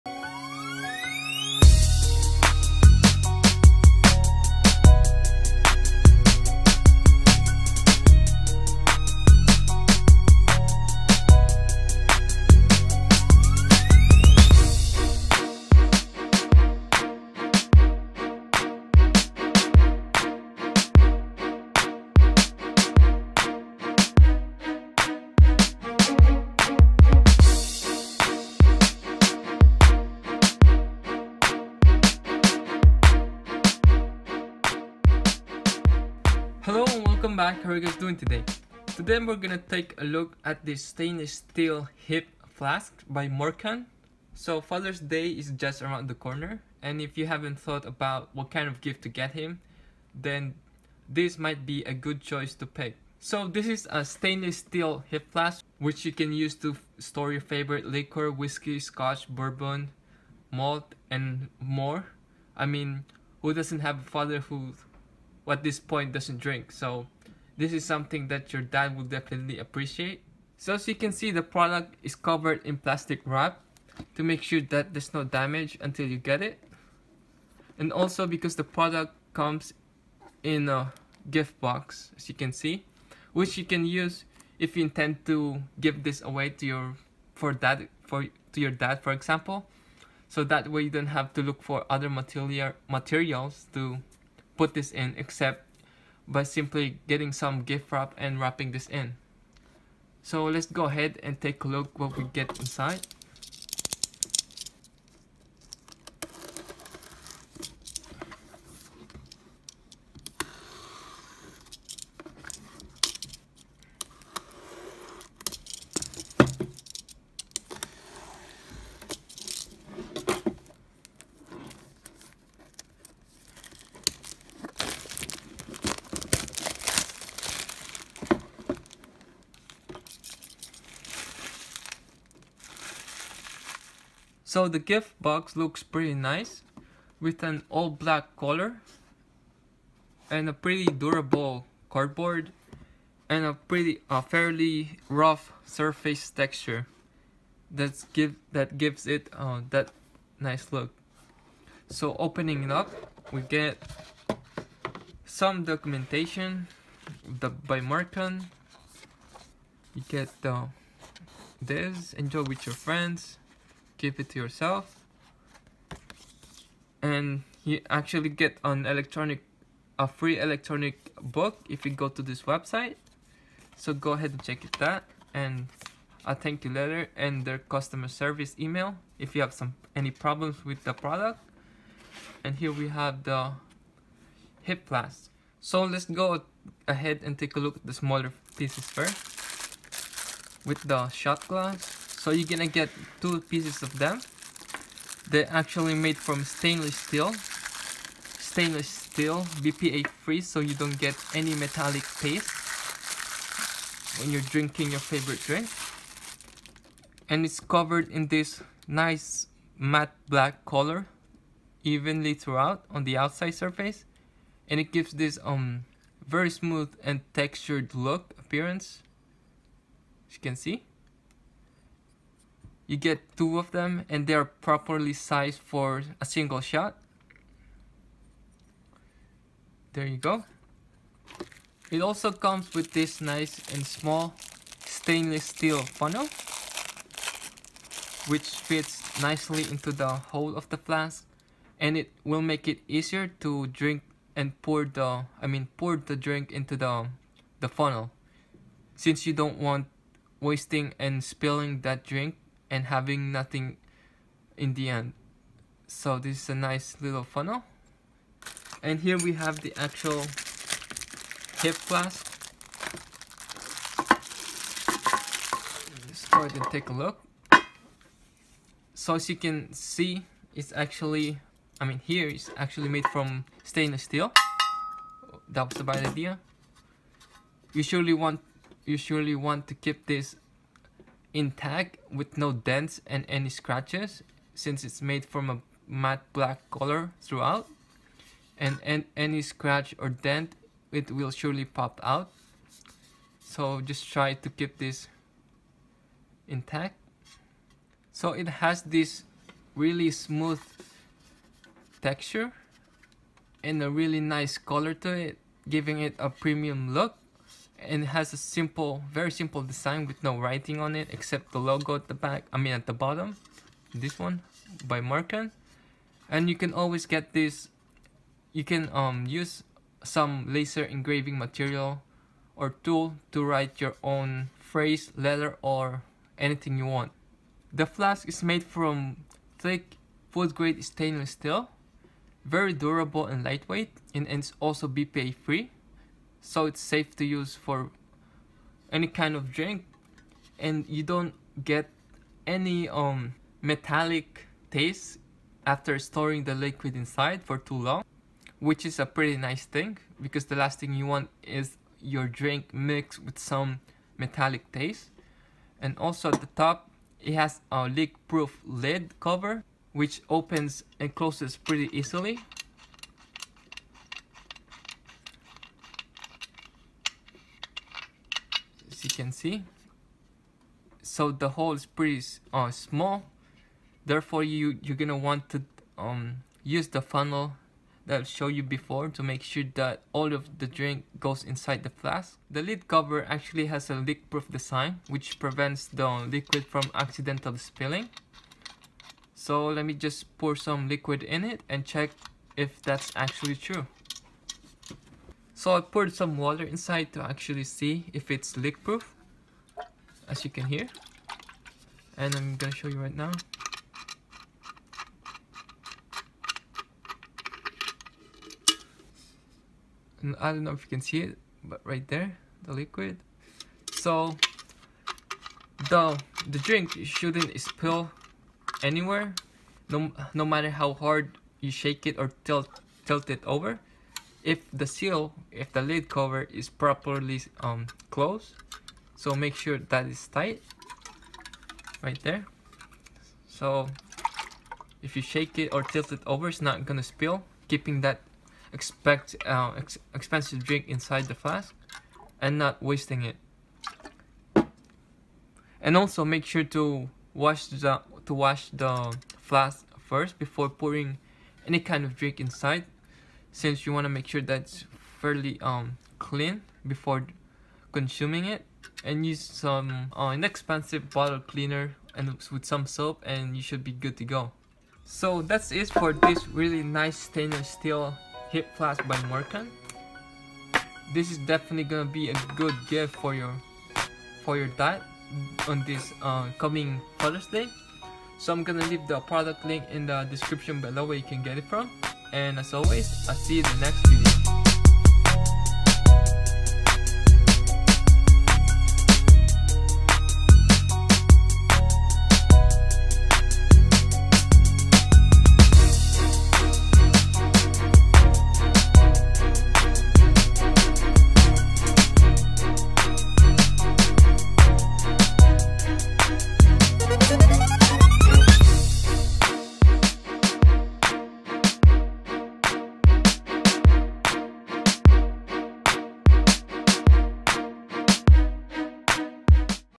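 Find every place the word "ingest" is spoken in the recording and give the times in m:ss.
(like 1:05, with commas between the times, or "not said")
not said.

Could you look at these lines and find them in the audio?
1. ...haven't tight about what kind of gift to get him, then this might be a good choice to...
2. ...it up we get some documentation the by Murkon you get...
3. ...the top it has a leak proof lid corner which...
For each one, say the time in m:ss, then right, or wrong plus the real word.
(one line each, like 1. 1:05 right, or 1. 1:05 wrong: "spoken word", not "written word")
1. 0:47 wrong: "thought", not "tight"
2. 2:32 right
3. 5:56 wrong: "cover", not "corner".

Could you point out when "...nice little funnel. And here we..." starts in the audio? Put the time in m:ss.
4:16.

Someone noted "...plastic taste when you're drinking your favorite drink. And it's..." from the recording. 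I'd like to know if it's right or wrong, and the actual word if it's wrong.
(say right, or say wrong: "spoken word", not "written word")
wrong: "metallic", not "plastic".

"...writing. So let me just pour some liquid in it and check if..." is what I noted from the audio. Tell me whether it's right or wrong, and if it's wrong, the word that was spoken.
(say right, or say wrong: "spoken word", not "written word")
wrong: "spilling", not "writing".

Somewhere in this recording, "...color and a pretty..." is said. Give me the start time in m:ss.
2:18.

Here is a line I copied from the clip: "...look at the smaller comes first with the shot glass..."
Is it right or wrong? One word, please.
wrong.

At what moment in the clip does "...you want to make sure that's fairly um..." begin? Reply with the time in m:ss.
7:33.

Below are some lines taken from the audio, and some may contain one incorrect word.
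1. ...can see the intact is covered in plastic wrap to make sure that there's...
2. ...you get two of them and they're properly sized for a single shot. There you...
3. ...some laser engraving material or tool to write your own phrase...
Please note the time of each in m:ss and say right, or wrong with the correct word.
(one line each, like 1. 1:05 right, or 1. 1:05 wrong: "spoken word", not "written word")
1. 1:10 wrong: "product", not "intact"
2. 3:42 right
3. 5:20 right.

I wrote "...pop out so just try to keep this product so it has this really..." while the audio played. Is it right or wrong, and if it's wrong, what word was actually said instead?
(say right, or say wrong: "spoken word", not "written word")
wrong: "intact", not "product".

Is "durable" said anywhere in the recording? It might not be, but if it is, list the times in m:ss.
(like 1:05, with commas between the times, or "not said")
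2:20, 5:32.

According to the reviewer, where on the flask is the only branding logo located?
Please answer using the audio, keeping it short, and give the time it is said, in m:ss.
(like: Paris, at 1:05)
At the bottom, at 5:12.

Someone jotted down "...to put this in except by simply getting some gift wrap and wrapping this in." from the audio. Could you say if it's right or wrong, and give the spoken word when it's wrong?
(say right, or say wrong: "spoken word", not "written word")
right.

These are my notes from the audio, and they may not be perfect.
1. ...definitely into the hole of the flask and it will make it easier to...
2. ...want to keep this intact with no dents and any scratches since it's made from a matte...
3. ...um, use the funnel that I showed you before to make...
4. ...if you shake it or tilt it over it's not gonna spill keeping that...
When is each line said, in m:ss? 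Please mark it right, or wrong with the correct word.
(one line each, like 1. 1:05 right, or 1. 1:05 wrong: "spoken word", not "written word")
1. 3:59 wrong: "nicely", not "definitely"
2. 4:39 right
3. 6:15 right
4. 7:15 right.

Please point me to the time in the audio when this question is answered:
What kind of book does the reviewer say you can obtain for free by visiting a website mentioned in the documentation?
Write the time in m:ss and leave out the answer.
2:50.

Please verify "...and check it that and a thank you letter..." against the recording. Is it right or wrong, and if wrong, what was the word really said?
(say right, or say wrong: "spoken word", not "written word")
right.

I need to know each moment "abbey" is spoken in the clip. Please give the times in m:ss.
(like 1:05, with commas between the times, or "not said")
not said.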